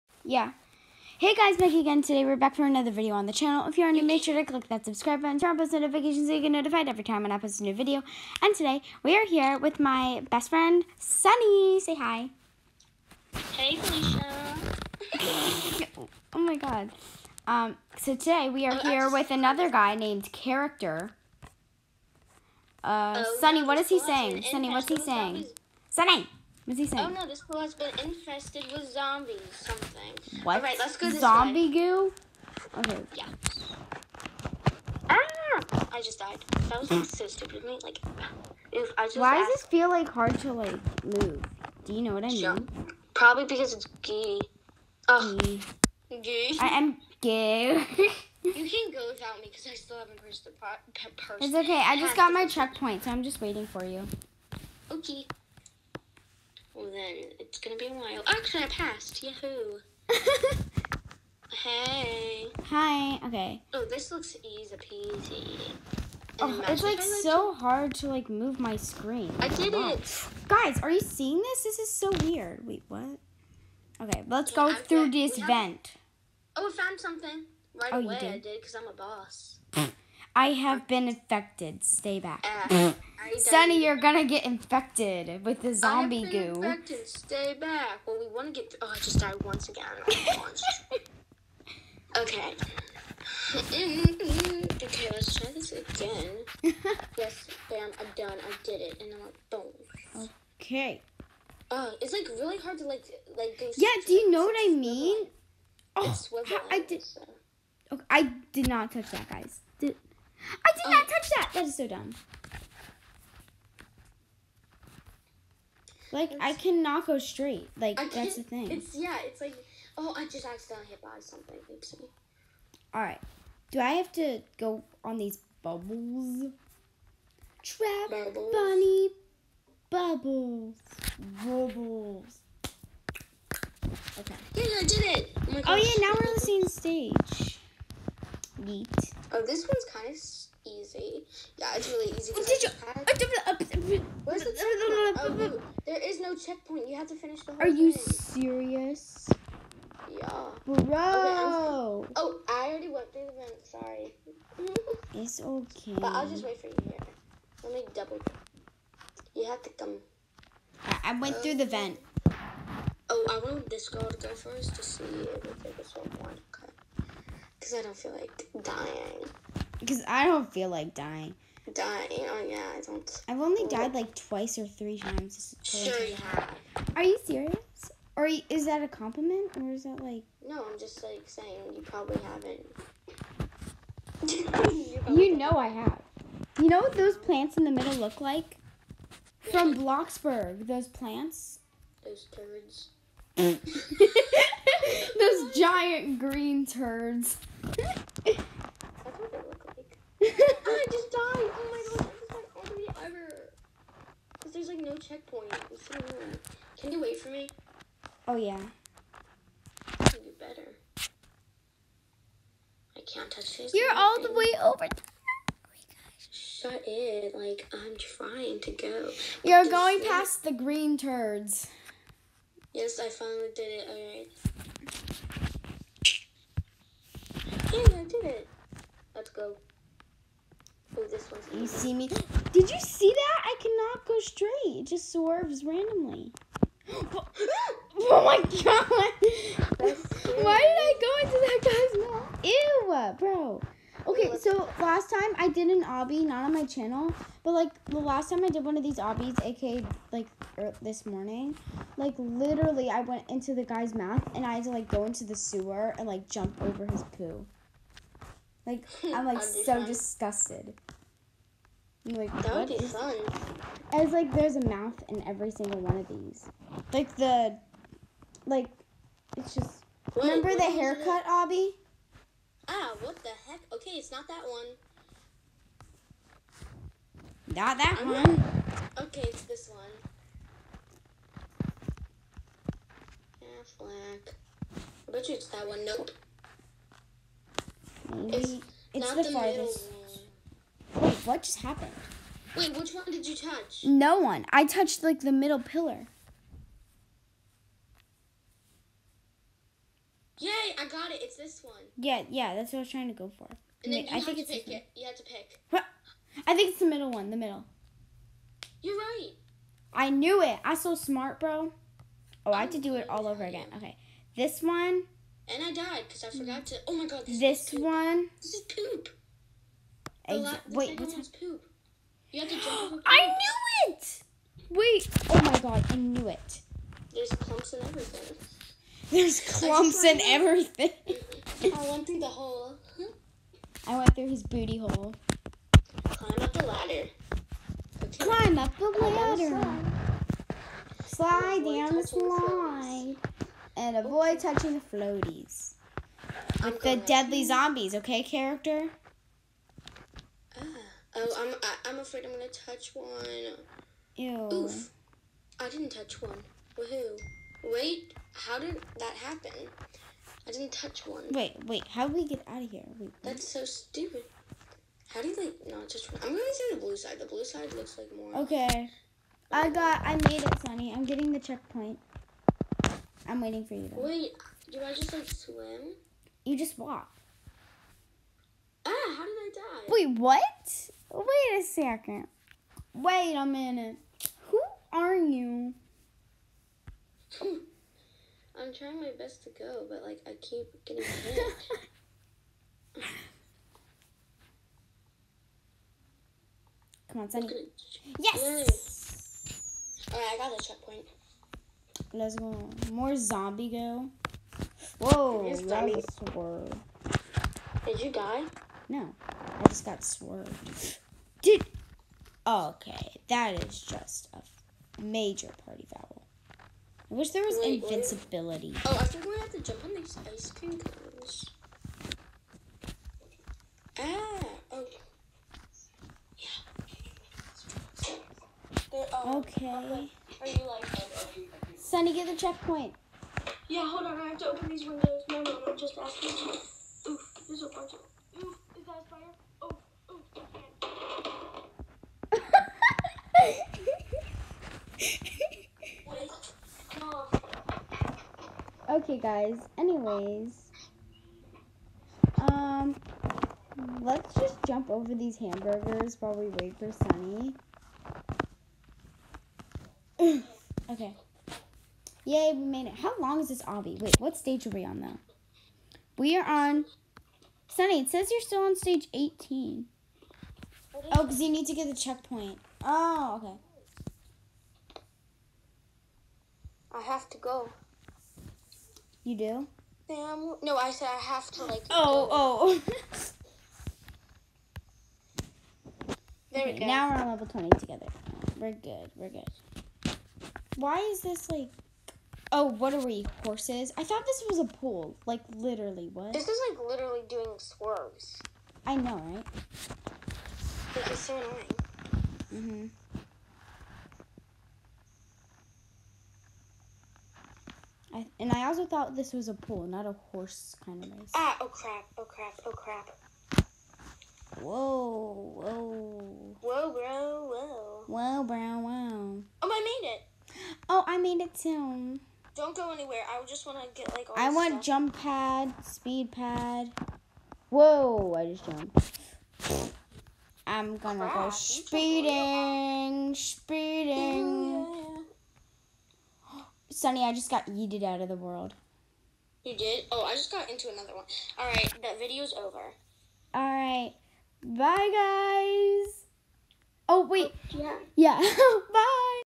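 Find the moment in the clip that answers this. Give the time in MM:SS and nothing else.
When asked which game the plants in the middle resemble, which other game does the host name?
03:09.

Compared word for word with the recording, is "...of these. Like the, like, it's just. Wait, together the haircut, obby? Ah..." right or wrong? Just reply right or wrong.
wrong.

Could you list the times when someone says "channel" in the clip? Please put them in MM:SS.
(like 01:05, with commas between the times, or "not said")
00:03, 04:06.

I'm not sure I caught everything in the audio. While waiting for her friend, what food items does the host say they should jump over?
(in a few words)
Hamburgers.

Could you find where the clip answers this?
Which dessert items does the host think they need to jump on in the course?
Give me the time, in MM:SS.
07:00.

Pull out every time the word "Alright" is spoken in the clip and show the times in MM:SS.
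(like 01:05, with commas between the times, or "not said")
03:43, 06:40.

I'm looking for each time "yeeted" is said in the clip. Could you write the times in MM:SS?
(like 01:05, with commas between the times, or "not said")
08:57.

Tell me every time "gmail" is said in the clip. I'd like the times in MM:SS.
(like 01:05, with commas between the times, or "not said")
not said.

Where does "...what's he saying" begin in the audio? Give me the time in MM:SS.
00:24.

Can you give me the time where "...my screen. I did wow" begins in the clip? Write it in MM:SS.
01:08.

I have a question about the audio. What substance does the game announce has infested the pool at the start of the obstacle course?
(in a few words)
Zombie goo.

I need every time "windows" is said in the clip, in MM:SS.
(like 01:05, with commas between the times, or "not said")
07:14.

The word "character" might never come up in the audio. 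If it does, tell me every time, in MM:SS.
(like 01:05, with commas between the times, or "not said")
00:20, 05:48.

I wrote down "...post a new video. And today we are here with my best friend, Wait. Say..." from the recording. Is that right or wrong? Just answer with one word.
wrong.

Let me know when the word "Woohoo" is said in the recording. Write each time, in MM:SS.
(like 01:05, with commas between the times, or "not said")
05:56.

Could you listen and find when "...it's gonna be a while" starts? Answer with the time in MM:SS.
00:57.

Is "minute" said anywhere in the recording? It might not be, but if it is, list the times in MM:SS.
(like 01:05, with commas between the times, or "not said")
06:23.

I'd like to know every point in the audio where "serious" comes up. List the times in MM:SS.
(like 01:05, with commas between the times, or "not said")
02:28, 02:57.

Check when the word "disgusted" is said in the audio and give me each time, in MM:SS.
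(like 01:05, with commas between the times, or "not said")
04:19.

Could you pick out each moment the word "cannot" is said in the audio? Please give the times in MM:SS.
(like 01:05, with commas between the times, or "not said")
01:56, 03:53.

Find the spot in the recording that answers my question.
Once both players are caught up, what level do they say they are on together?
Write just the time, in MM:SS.
08:07.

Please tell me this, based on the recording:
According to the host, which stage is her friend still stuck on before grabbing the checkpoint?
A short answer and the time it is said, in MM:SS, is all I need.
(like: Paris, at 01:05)
18, at 07:48.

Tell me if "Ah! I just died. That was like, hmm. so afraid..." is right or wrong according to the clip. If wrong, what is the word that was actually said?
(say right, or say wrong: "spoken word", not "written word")
wrong: "stupid", not "afraid".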